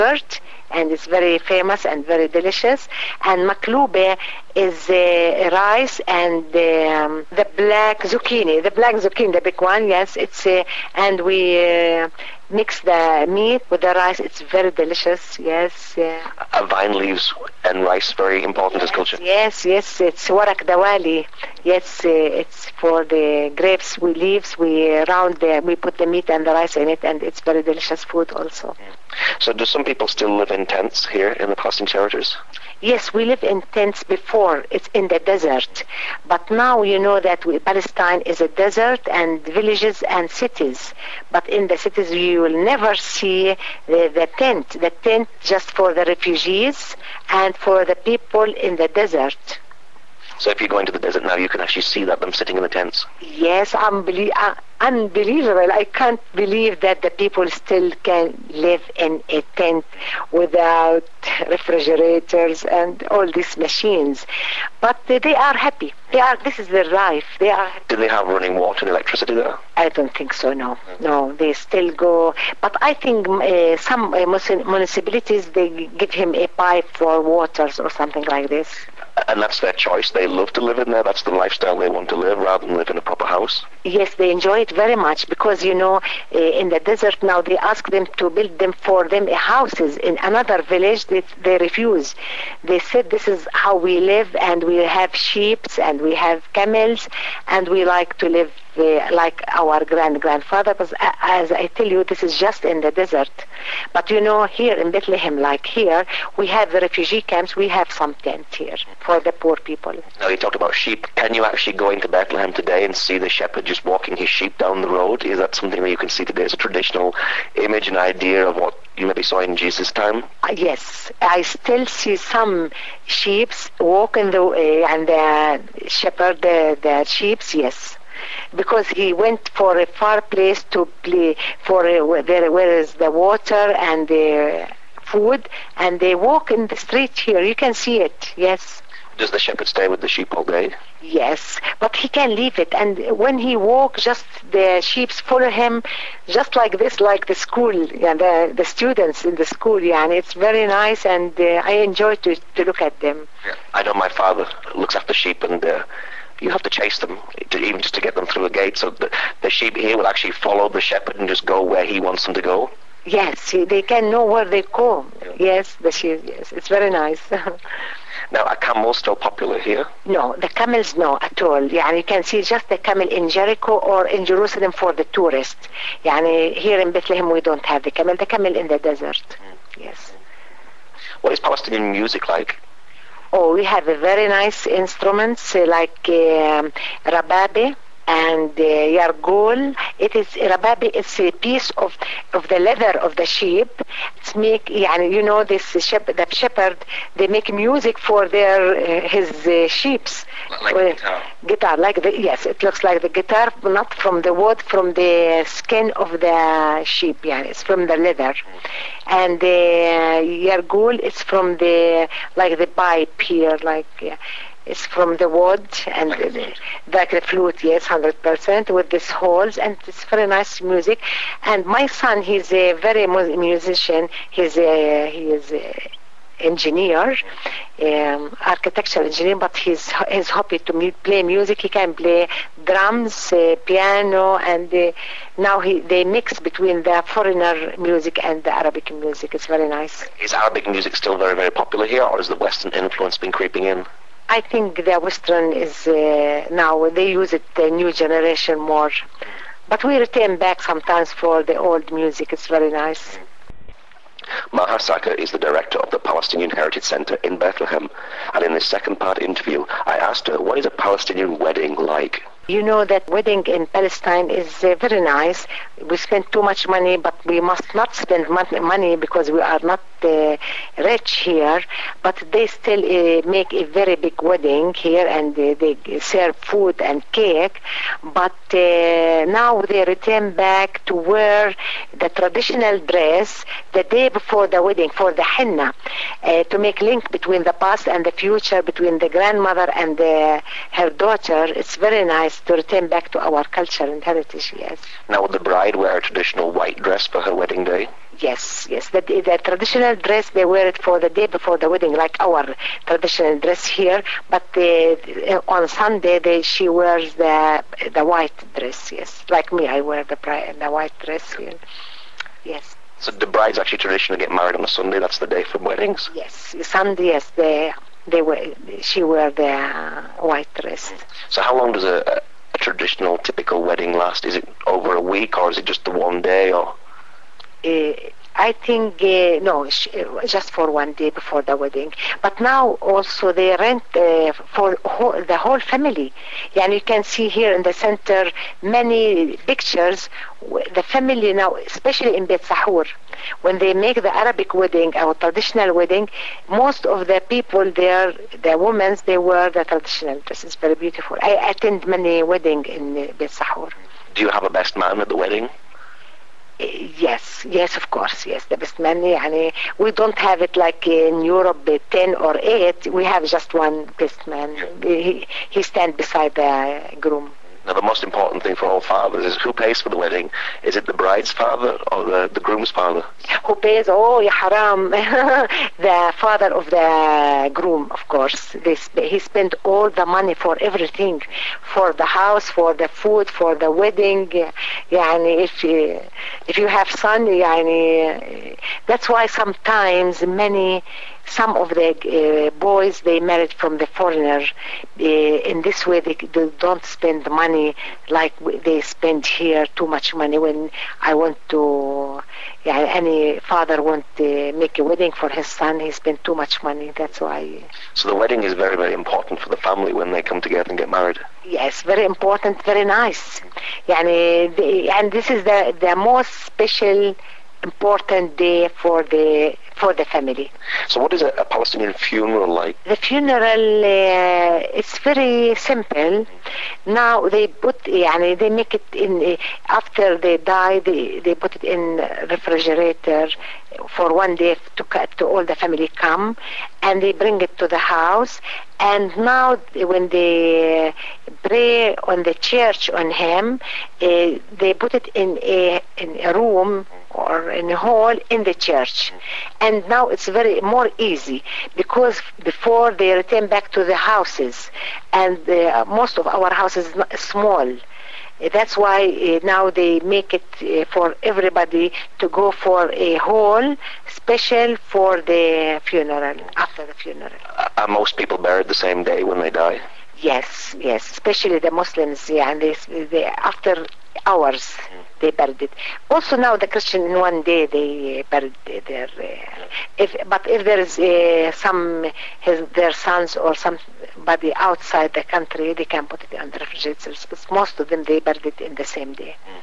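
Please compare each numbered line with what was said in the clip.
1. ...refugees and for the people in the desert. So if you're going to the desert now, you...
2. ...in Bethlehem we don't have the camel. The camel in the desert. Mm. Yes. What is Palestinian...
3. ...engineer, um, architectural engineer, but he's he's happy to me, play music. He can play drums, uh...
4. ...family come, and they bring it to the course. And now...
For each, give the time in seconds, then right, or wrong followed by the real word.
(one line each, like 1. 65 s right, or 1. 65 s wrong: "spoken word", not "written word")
1. 46 s right
2. 176 s right
3. 226 s right
4. 435 s wrong: "house", not "course".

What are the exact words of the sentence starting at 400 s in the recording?
When I want to, yeah, any father want to make a wedding for his son, he spent too much money.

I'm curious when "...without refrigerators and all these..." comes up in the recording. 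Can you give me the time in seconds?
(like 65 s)
60 s.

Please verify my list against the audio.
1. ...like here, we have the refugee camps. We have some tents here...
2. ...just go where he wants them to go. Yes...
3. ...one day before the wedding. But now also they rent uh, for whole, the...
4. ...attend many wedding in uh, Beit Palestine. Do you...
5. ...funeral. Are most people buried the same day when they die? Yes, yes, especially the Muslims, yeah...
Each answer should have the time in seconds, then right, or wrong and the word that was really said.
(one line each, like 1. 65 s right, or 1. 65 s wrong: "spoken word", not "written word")
1. 105 s right
2. 161 s right
3. 330 s right
4. 351 s wrong: "Sahur", not "Palestine"
5. 466 s right.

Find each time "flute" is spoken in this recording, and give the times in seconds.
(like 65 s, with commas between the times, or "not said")
217 s.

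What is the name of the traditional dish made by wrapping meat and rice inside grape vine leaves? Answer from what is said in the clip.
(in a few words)
warak dawali.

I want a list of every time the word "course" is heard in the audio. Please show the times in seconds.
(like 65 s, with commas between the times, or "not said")
357 s, 378 s.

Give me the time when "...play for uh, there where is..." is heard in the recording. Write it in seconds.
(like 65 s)
131 s.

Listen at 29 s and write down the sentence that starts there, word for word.
So, do some people still live in tents here in the Palestinian territories?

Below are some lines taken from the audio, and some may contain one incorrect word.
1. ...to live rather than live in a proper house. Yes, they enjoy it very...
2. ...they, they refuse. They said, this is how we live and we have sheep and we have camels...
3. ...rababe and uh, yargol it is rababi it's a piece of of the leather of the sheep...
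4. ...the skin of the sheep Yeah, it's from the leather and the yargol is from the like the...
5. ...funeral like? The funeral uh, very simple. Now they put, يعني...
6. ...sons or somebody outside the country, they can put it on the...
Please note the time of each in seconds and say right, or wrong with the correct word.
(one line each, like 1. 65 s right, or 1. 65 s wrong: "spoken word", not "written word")
1. 82 s right
2. 91 s right
3. 187 s right
4. 204 s right
5. 421 s right
6. 482 s right.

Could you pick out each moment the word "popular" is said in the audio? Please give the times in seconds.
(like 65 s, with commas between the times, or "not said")
169 s, 241 s.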